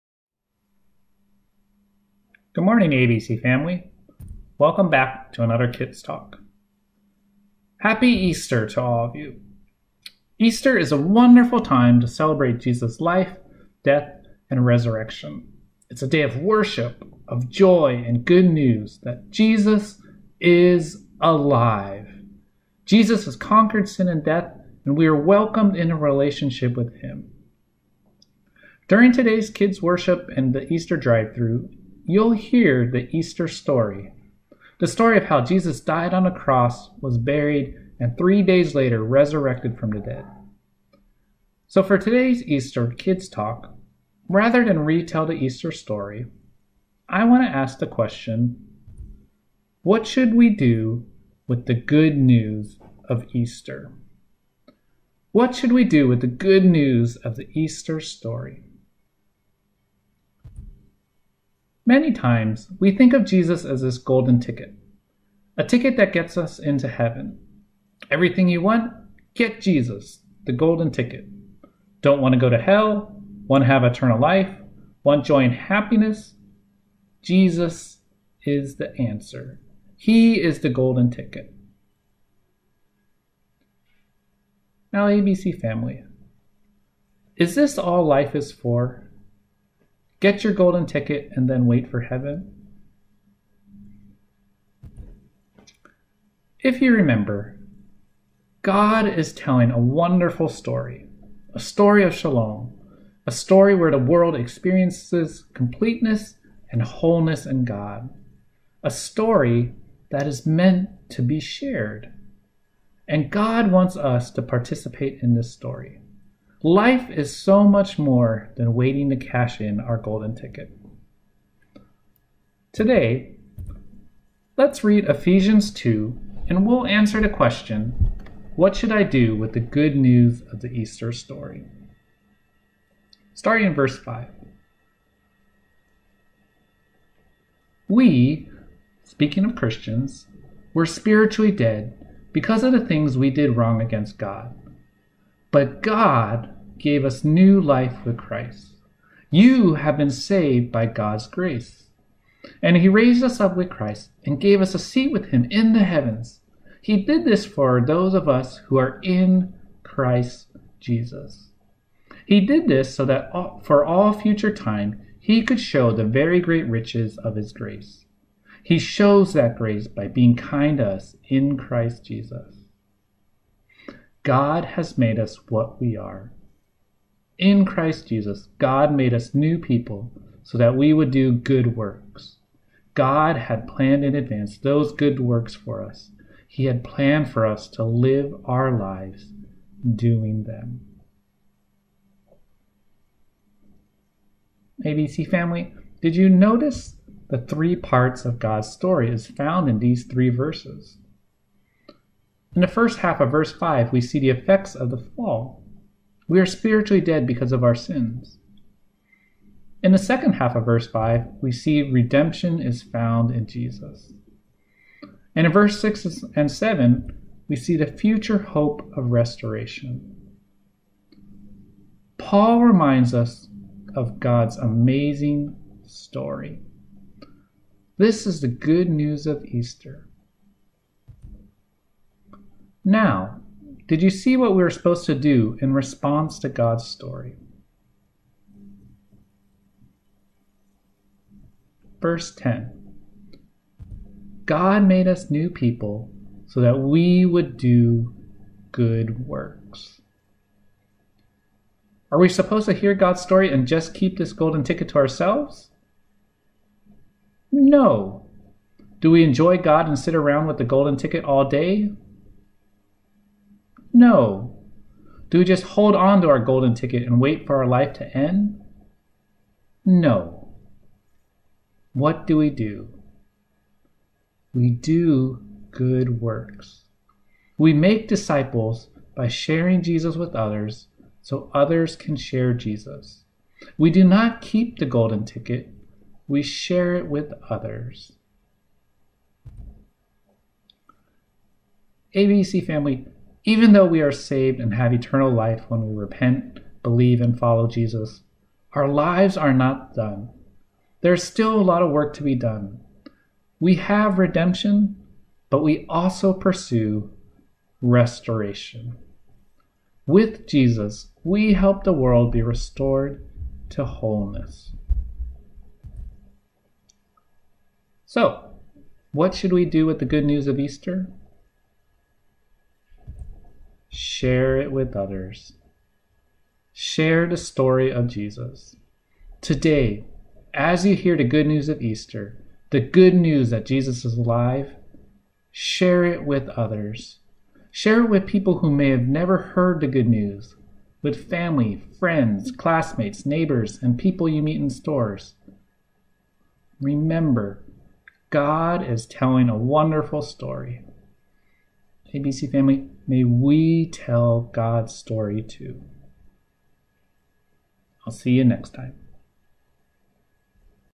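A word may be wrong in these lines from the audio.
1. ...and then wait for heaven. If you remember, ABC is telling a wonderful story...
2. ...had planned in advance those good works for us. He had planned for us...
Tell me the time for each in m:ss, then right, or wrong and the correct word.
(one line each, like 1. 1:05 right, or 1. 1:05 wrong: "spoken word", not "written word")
1. 1:31 wrong: "God", not "ABC"
2. 3:03 right.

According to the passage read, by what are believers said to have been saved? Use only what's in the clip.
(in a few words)
God's grace.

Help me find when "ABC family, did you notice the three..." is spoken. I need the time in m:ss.
3:14.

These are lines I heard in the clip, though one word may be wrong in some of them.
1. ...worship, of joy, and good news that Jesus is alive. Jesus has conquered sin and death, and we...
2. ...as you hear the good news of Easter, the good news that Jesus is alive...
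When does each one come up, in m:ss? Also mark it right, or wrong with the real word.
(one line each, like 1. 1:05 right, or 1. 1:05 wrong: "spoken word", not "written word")
1. 0:16 right
2. 5:30 right.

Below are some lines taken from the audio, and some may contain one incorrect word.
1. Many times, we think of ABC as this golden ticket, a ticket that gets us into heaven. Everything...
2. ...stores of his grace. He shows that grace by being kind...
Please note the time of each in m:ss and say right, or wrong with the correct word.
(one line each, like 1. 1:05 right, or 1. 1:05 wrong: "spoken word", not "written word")
1. 1:01 wrong: "Jesus", not "ABC"
2. 2:46 wrong: "riches", not "stores".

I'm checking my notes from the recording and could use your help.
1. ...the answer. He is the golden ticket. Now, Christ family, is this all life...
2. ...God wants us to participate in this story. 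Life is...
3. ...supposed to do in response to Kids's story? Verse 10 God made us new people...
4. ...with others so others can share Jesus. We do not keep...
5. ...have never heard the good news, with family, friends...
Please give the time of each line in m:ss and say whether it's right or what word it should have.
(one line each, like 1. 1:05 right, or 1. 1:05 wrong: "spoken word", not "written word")
1. 1:18 wrong: "ABC", not "Christ"
2. 1:53 right
3. 3:54 wrong: "God", not "Kids"
4. 4:40 right
5. 5:38 right.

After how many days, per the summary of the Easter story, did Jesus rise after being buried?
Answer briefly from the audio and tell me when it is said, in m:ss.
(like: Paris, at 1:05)
3, at 0:38.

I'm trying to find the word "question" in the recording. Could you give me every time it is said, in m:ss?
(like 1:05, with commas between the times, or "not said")
0:47, 2:07.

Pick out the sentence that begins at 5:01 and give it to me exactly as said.
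There's still a lot of work to be done.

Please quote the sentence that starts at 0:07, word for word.
Happy Easter to all of you.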